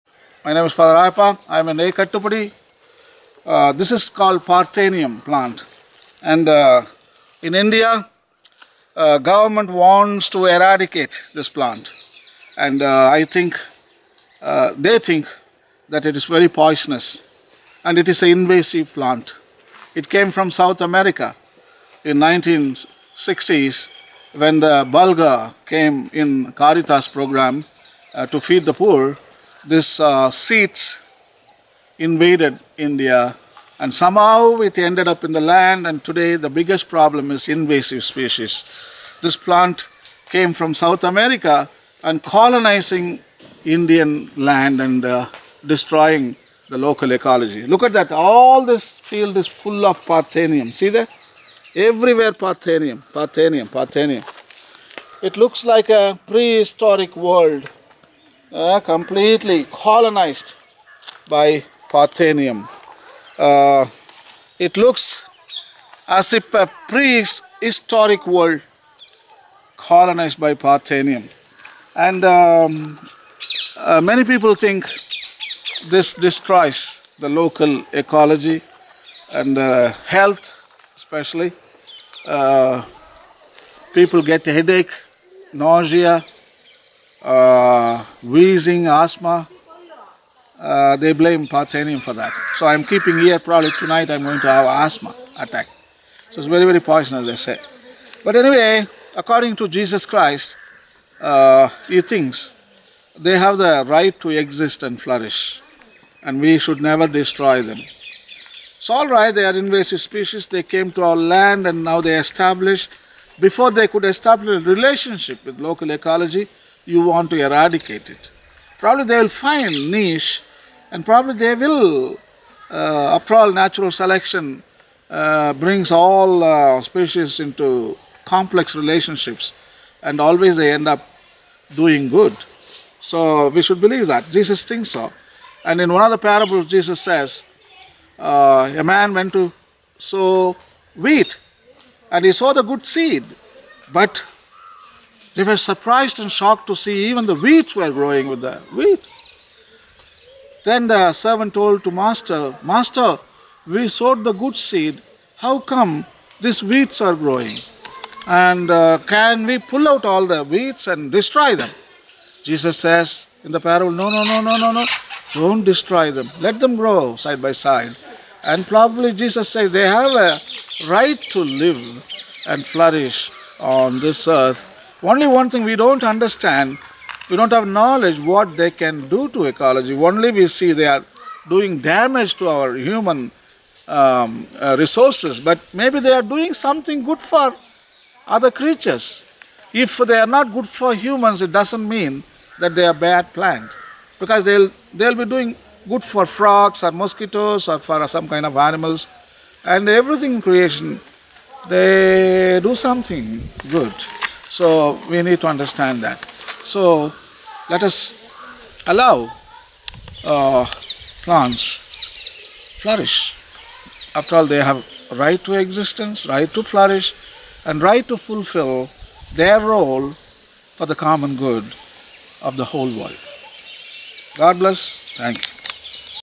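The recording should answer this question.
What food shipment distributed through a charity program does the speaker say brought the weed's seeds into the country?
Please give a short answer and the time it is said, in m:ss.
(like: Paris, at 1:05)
Bulgur, at 0:24.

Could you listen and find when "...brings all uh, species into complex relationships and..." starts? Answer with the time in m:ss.
2:05.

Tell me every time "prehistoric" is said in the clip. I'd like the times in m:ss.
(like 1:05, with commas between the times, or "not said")
0:56, 1:06.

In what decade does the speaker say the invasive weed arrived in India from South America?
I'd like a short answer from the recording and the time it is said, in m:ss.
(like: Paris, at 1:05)
1960s, at 0:22.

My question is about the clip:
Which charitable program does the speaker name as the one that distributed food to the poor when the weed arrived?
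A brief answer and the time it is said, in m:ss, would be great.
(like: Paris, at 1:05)
Caritas, at 0:26.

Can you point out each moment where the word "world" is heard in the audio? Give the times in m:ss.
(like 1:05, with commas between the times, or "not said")
0:57, 1:08, 3:42.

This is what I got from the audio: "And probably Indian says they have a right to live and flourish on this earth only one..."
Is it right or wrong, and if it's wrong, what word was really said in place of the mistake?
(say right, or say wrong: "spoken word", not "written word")
wrong: "Jesus", not "Indian".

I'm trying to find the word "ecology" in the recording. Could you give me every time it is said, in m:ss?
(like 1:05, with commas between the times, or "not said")
0:47, 1:17, 1:55, 2:59.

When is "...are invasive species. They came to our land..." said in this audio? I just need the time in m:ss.
1:49.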